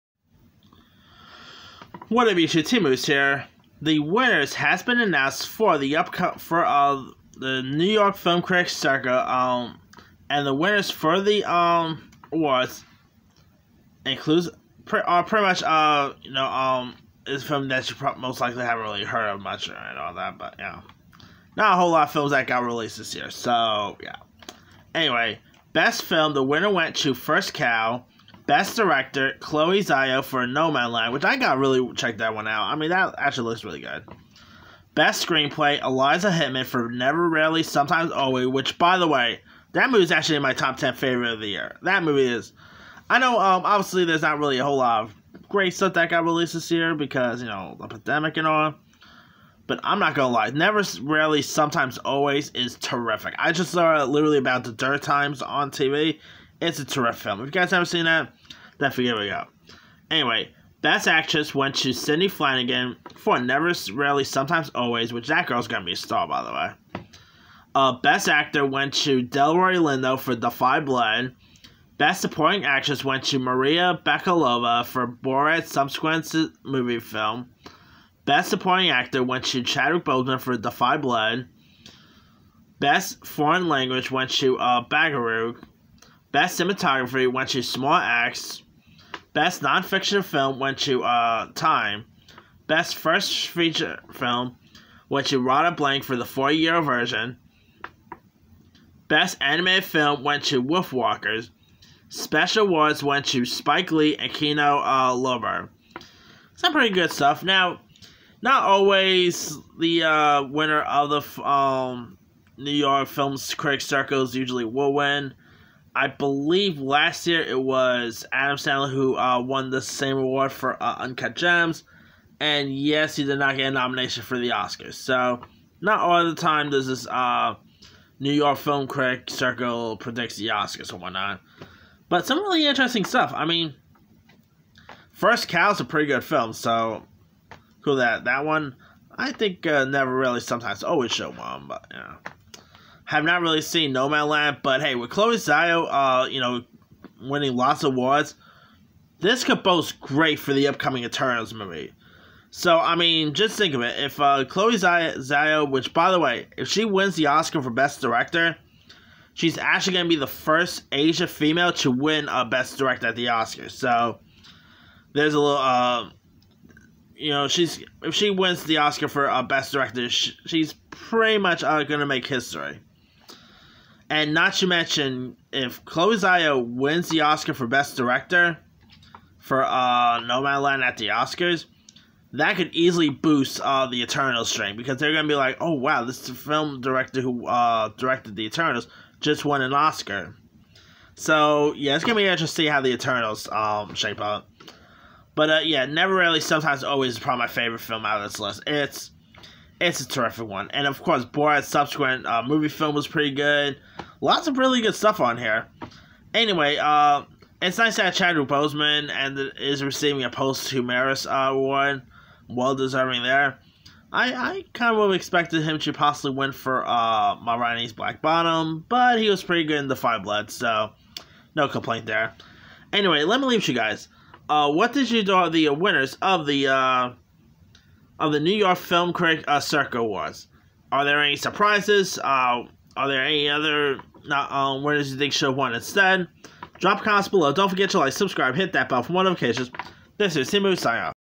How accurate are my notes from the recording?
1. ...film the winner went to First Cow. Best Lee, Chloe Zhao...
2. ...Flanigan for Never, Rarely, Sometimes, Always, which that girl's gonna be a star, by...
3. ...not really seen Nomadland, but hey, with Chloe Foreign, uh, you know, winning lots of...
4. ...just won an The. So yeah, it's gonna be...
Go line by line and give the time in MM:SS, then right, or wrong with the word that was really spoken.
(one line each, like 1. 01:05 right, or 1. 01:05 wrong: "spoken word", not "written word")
1. 00:26 wrong: "Director", not "Lee"
2. 01:02 right
3. 02:23 wrong: "Zhao", not "Foreign"
4. 03:09 wrong: "Oscar", not "The".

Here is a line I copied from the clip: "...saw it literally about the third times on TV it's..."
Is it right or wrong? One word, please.
right.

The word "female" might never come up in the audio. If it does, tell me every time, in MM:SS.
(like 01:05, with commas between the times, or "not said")
02:41.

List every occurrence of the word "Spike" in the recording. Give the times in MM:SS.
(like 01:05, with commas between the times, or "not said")
01:43.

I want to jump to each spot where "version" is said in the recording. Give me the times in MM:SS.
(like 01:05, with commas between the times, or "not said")
01:36.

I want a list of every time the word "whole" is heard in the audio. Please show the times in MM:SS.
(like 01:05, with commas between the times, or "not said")
00:21, 00:44.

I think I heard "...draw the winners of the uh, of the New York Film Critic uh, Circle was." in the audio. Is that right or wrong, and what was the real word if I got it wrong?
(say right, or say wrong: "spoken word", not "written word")
right.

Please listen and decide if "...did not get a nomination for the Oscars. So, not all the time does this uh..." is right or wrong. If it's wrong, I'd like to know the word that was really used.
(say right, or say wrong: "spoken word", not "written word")
right.